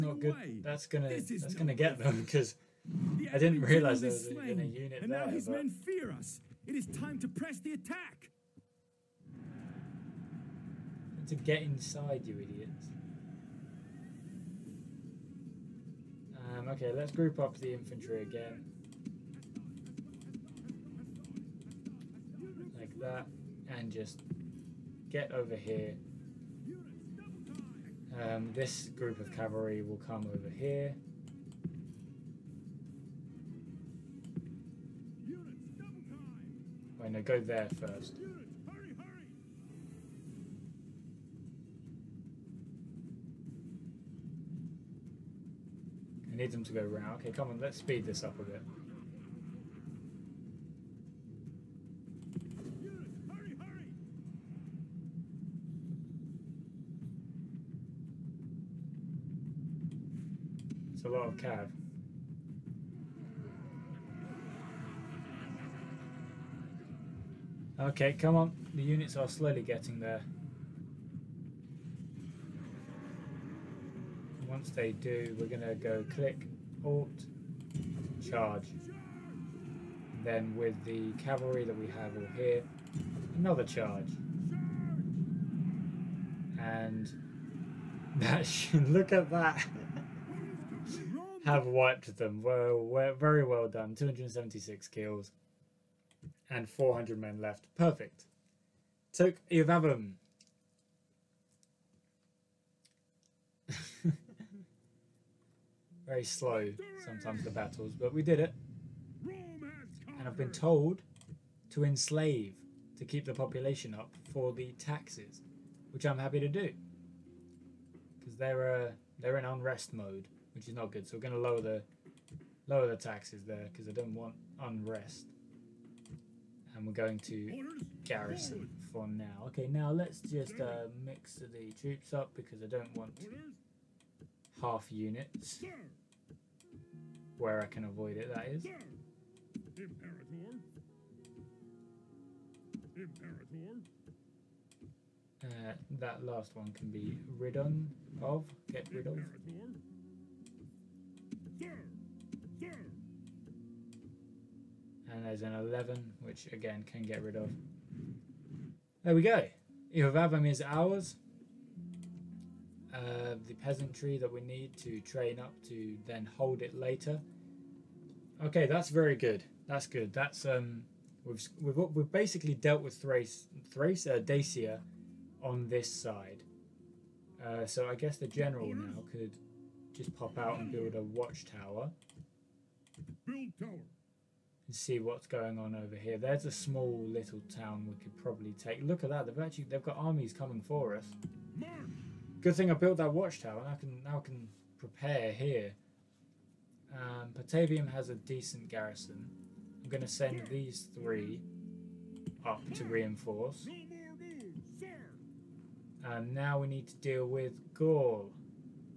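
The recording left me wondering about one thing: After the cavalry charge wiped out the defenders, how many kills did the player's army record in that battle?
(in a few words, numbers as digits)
276.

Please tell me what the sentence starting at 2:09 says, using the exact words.
Okay, now let's just uh, mix the troops up because I don't want half units where I can avoid it, that is.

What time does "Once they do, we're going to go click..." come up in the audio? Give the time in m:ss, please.
1:14.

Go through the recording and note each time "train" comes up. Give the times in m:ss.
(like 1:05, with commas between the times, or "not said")
2:44.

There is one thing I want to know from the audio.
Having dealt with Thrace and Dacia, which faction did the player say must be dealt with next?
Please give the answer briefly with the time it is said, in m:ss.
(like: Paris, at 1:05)
Gaul, at 3:27.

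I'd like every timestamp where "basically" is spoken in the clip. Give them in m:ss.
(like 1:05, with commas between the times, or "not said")
2:52.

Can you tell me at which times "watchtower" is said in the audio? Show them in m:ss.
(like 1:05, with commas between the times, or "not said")
3:01, 3:13.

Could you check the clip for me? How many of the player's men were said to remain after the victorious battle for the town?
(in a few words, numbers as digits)
400.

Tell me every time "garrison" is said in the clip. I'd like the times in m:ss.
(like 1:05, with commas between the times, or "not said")
2:08, 3:18.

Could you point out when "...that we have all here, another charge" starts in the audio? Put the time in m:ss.
1:21.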